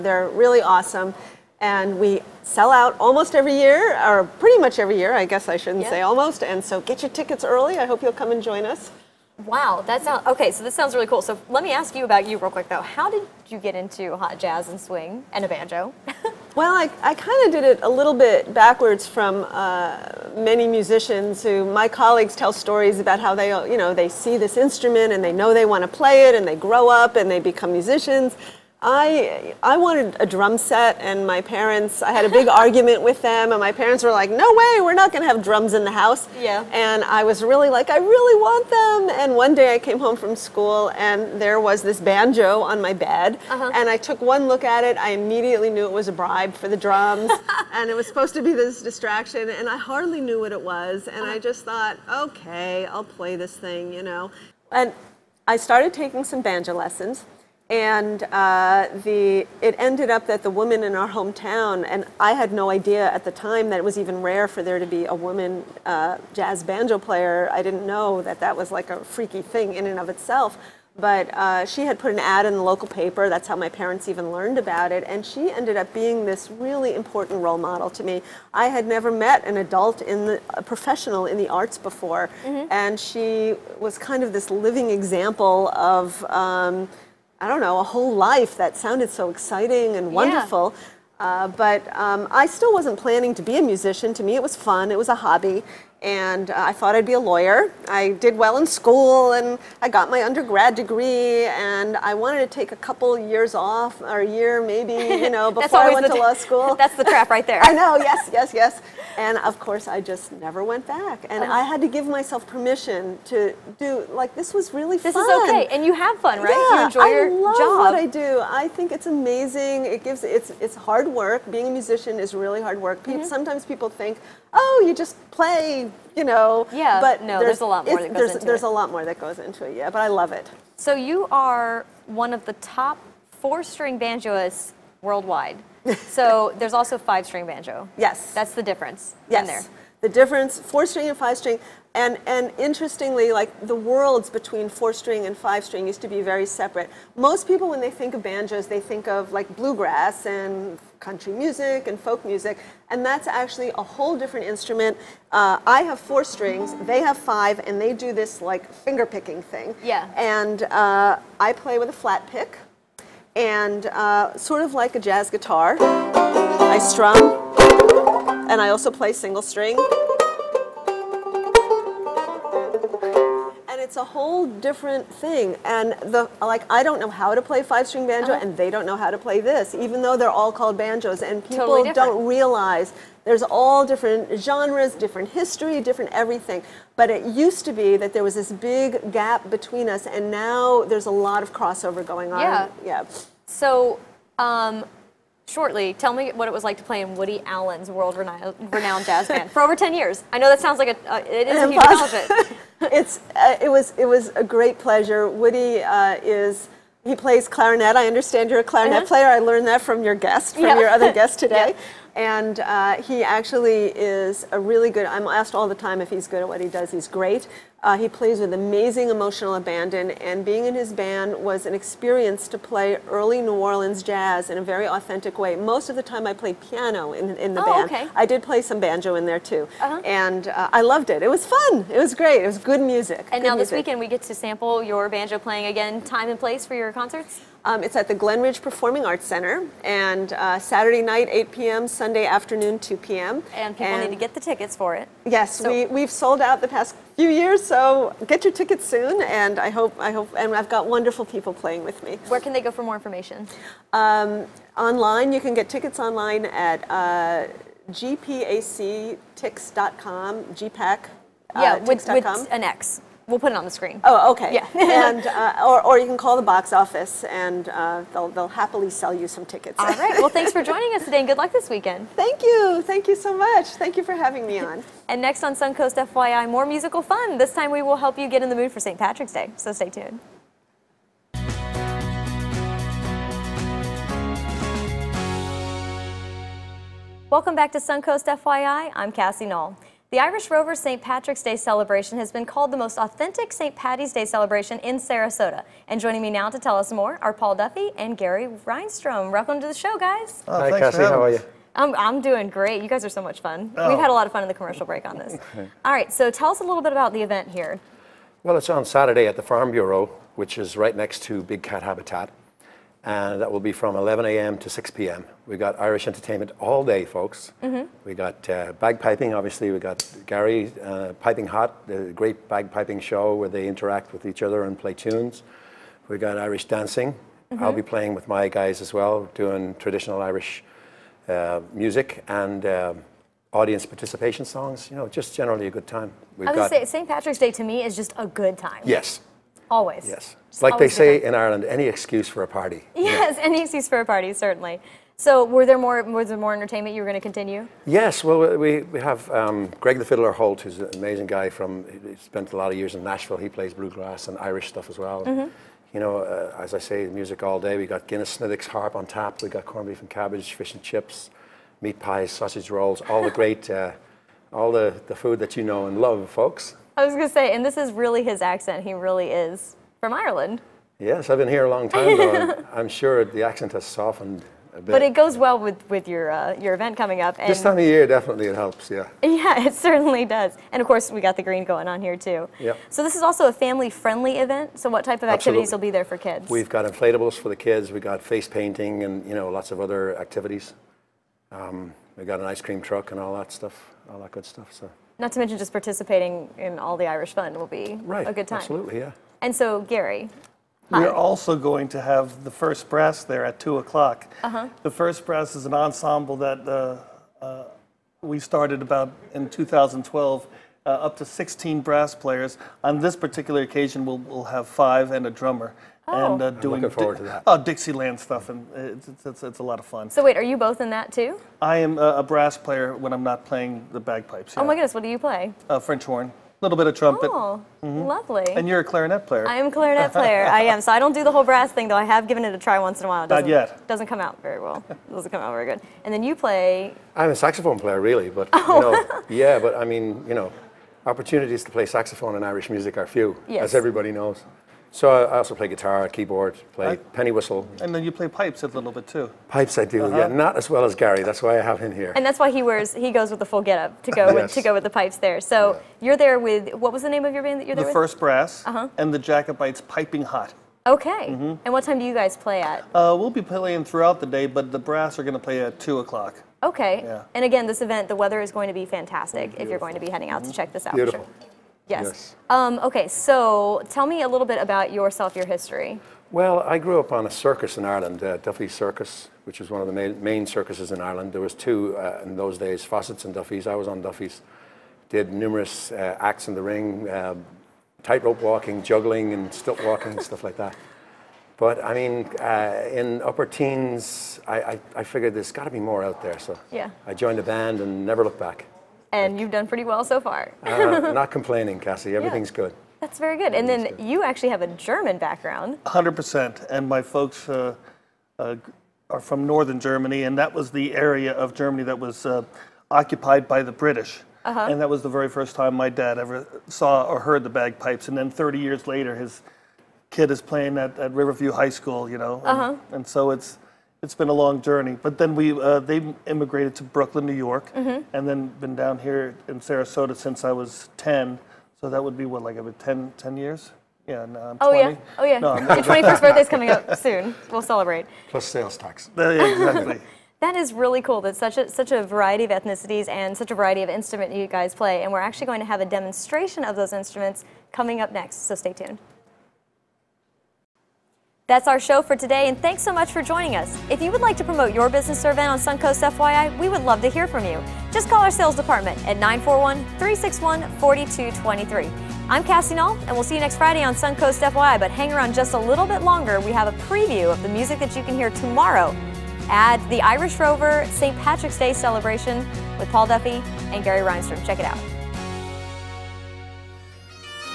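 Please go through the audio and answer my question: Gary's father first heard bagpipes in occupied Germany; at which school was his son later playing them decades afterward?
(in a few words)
Riverview High School.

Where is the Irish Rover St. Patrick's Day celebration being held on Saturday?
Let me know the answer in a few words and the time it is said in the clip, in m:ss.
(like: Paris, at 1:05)
The Farm Bureau, at 5:09.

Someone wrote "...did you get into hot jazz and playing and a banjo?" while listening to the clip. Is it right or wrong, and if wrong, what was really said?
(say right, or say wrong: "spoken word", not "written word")
wrong: "swing", not "playing".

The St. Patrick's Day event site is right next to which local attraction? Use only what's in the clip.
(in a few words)
Big Cat Habitat.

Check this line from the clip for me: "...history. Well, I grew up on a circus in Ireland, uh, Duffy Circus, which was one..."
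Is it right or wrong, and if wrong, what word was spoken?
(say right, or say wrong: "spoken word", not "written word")
right.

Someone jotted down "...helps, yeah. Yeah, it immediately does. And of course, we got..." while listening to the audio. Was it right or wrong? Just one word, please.
wrong.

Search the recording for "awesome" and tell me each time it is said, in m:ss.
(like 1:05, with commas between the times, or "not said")
0:00.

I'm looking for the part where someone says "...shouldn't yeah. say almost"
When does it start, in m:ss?
0:05.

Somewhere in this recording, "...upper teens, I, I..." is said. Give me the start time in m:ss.
8:13.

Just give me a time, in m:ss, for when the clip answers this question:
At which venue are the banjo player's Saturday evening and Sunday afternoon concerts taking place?
3:58.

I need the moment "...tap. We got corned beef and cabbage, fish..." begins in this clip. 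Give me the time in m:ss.
5:59.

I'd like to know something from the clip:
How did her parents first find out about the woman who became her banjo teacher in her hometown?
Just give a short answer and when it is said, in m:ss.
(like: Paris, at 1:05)
An ad in the local paper, at 1:12.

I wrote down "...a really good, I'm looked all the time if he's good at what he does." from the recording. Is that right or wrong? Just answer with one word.
wrong.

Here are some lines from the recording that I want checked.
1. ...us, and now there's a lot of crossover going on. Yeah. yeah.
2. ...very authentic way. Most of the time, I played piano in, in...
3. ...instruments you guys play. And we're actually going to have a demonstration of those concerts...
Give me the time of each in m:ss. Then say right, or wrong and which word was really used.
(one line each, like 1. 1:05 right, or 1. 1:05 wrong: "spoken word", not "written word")
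1. 3:09 right
2. 3:44 right
3. 9:03 wrong: "instruments", not "concerts".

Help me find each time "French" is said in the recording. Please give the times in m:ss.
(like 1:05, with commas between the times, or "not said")
7:05.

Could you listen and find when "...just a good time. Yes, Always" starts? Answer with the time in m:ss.
5:37.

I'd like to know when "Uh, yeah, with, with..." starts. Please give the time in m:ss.
4:21.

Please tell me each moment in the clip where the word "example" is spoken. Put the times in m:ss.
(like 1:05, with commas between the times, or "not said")
1:24.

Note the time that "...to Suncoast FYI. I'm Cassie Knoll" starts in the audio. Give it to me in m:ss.
4:47.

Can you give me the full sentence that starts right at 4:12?
Where can they go for more information?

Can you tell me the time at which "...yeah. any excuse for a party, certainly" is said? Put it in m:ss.
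5:43.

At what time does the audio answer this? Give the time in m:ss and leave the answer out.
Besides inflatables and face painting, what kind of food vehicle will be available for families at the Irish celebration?
6:32.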